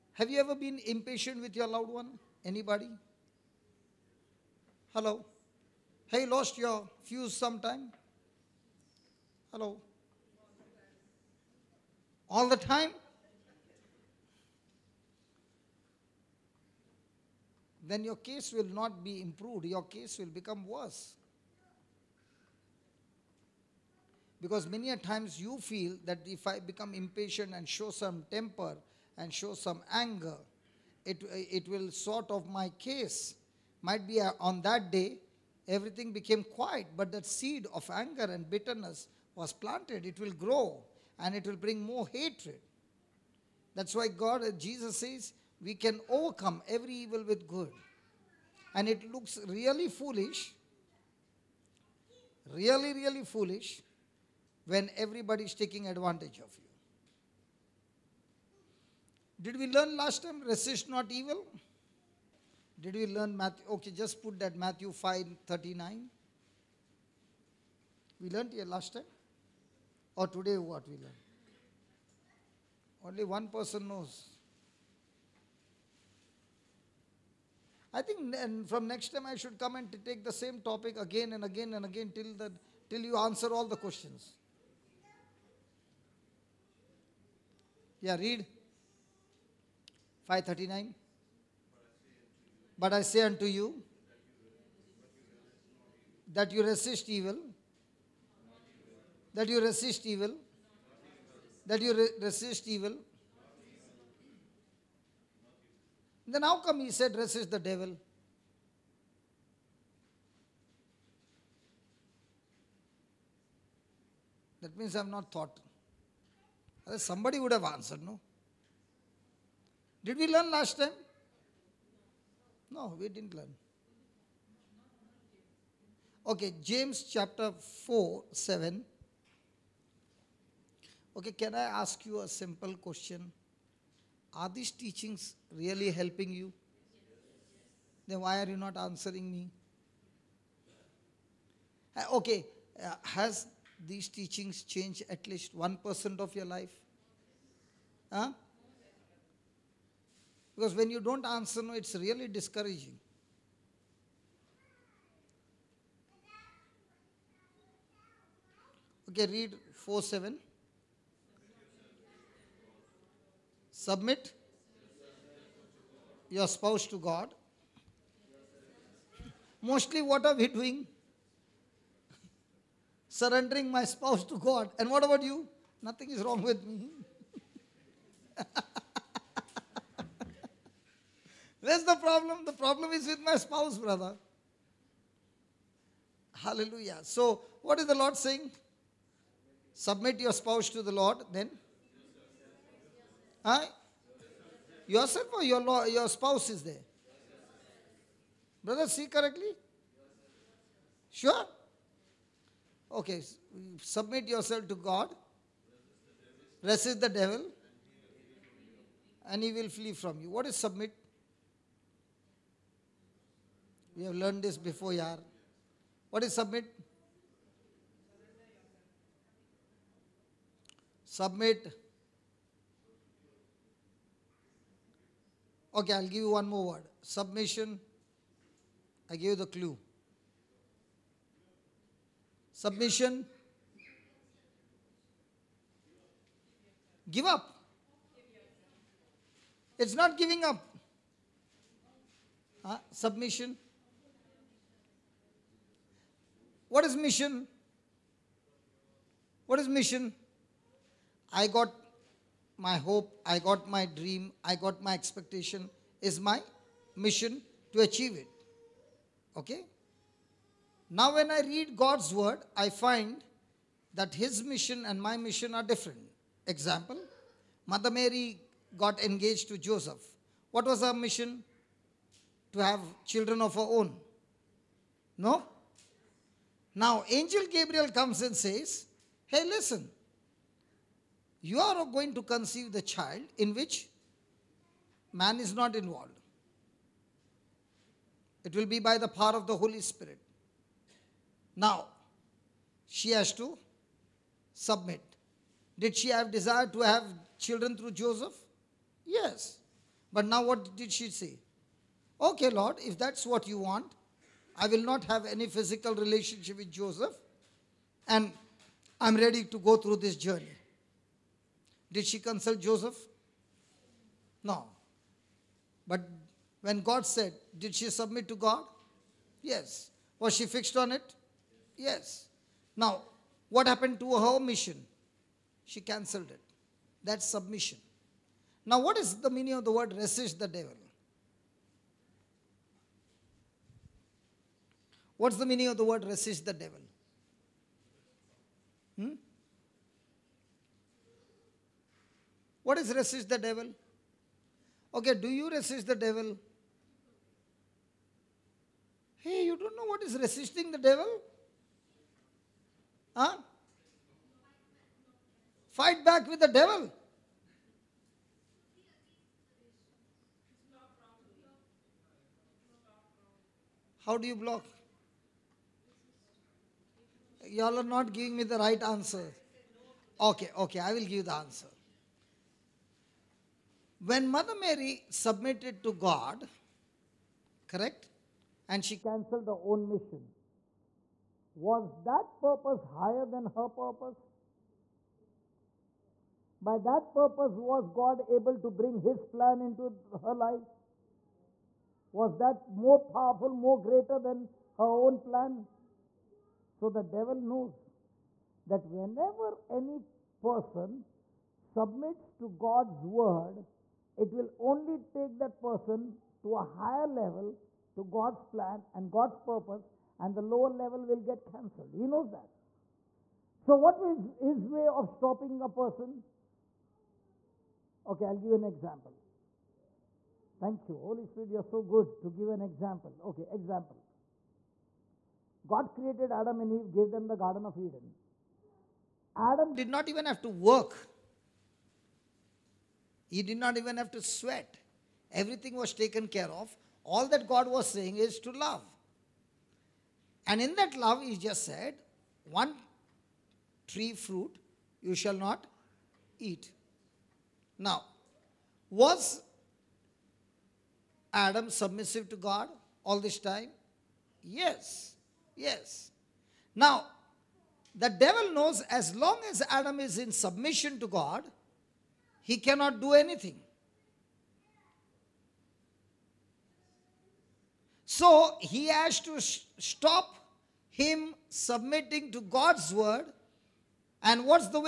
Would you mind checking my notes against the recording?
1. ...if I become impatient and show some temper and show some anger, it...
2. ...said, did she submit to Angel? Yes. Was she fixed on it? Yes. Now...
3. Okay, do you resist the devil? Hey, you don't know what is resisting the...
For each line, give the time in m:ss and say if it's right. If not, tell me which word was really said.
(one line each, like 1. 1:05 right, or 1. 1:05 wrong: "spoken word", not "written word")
1. 0:26 right
2. 5:17 wrong: "God", not "Angel"
3. 5:44 right.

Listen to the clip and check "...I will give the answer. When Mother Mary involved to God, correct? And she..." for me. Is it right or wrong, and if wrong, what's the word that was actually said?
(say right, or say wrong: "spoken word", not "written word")
wrong: "submitted", not "involved".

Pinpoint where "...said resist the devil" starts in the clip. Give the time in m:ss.
1:46.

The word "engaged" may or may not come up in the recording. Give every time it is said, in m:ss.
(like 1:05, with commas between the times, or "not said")
4:29.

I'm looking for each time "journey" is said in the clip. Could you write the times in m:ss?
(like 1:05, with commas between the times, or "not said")
5:10.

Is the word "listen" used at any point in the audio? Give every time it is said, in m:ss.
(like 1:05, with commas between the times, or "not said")
4:39.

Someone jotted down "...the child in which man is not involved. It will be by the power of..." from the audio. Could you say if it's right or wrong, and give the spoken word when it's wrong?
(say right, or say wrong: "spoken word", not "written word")
right.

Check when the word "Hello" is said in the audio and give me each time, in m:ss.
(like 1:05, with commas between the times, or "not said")
0:04, 0:09.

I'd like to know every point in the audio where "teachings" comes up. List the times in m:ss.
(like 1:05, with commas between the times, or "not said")
2:14, 2:24.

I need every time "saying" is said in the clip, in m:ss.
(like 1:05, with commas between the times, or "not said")
3:08, 7:17.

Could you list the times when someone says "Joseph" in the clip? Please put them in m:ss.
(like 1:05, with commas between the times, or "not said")
4:29, 4:57, 5:06, 5:12.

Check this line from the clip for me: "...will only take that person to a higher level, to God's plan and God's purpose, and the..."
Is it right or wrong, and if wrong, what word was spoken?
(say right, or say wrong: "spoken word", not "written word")
right.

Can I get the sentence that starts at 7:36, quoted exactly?
Now, the devil knows as long as Adam is in submission to God, he cannot do anything.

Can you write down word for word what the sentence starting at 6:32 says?
Was that more powerful, more greater than her own plan?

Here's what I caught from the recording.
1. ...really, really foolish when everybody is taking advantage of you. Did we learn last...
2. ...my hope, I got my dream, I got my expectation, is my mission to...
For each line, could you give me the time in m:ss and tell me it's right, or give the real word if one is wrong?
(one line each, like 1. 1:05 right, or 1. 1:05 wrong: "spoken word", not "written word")
1. 0:52 right
2. 4:12 right.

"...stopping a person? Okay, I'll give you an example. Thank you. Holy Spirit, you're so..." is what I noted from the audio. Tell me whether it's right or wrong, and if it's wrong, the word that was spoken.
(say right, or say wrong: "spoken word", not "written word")
right.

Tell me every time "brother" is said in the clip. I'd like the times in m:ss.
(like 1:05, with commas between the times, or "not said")
3:03, 3:18.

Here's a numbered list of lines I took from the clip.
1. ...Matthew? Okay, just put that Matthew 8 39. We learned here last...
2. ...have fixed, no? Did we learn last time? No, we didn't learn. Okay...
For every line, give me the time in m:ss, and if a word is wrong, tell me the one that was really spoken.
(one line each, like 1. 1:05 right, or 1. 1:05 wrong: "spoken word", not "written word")
1. 1:03 wrong: "5", not "8"
2. 1:57 wrong: "answered", not "fixed".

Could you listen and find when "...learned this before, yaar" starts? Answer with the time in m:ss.
3:34.